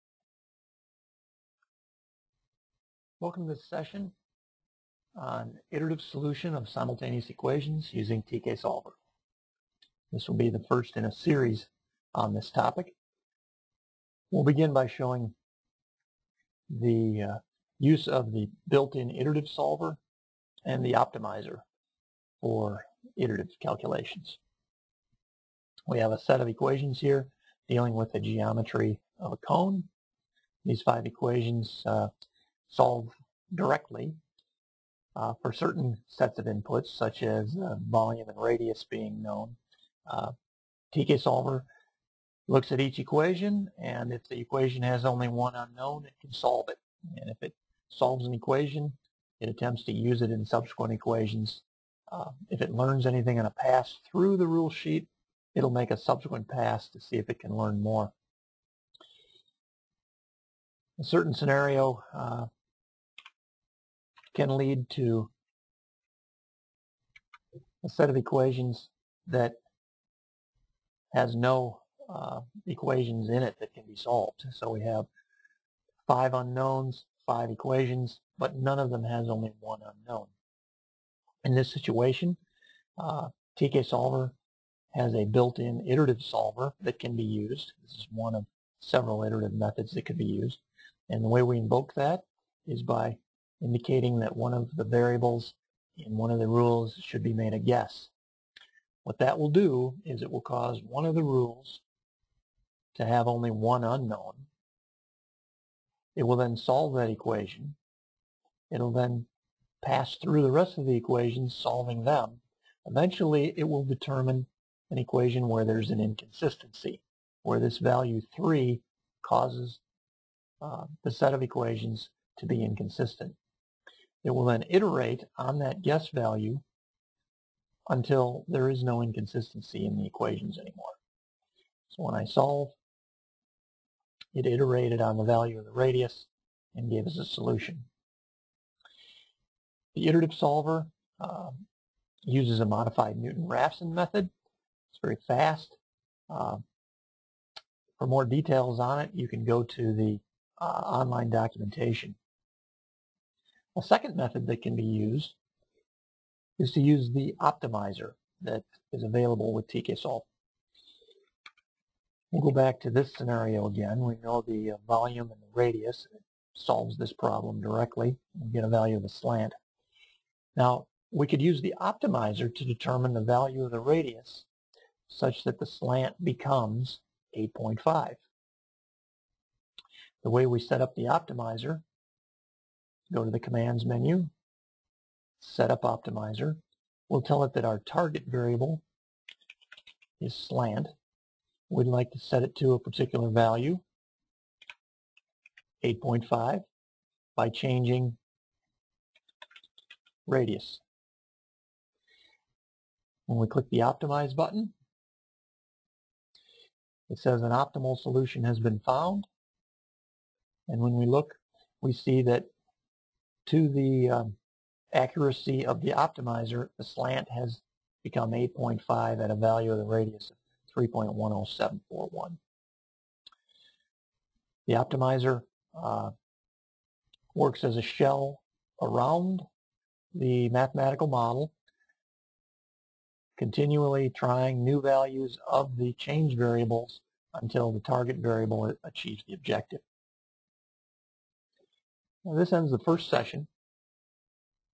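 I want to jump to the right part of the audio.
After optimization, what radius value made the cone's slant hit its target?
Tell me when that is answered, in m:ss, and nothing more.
3:40.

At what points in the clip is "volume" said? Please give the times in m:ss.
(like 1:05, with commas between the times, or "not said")
0:37, 2:44.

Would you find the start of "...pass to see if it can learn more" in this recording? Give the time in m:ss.
0:56.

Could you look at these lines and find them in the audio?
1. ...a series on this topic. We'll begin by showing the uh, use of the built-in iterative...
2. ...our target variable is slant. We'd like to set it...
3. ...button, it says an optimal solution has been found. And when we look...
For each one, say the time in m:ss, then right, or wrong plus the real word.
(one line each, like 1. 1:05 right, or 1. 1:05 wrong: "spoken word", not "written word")
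1. 0:11 right
2. 3:07 right
3. 3:24 right.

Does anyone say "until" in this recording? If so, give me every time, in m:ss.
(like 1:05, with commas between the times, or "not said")
2:07, 3:57.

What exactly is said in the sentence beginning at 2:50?
Now, we could use the optimizer to determine the value of the radius such that the slant becomes 8.5.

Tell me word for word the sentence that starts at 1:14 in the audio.
So we have five unknowns, five equations, but none of them has only one unknown.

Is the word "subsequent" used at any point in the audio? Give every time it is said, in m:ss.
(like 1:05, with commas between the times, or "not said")
0:50, 0:55.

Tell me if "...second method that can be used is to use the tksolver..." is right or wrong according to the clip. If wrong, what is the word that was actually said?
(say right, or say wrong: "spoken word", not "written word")
wrong: "optimizer", not "tksolver".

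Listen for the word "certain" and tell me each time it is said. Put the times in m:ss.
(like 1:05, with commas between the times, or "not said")
0:35, 1:01.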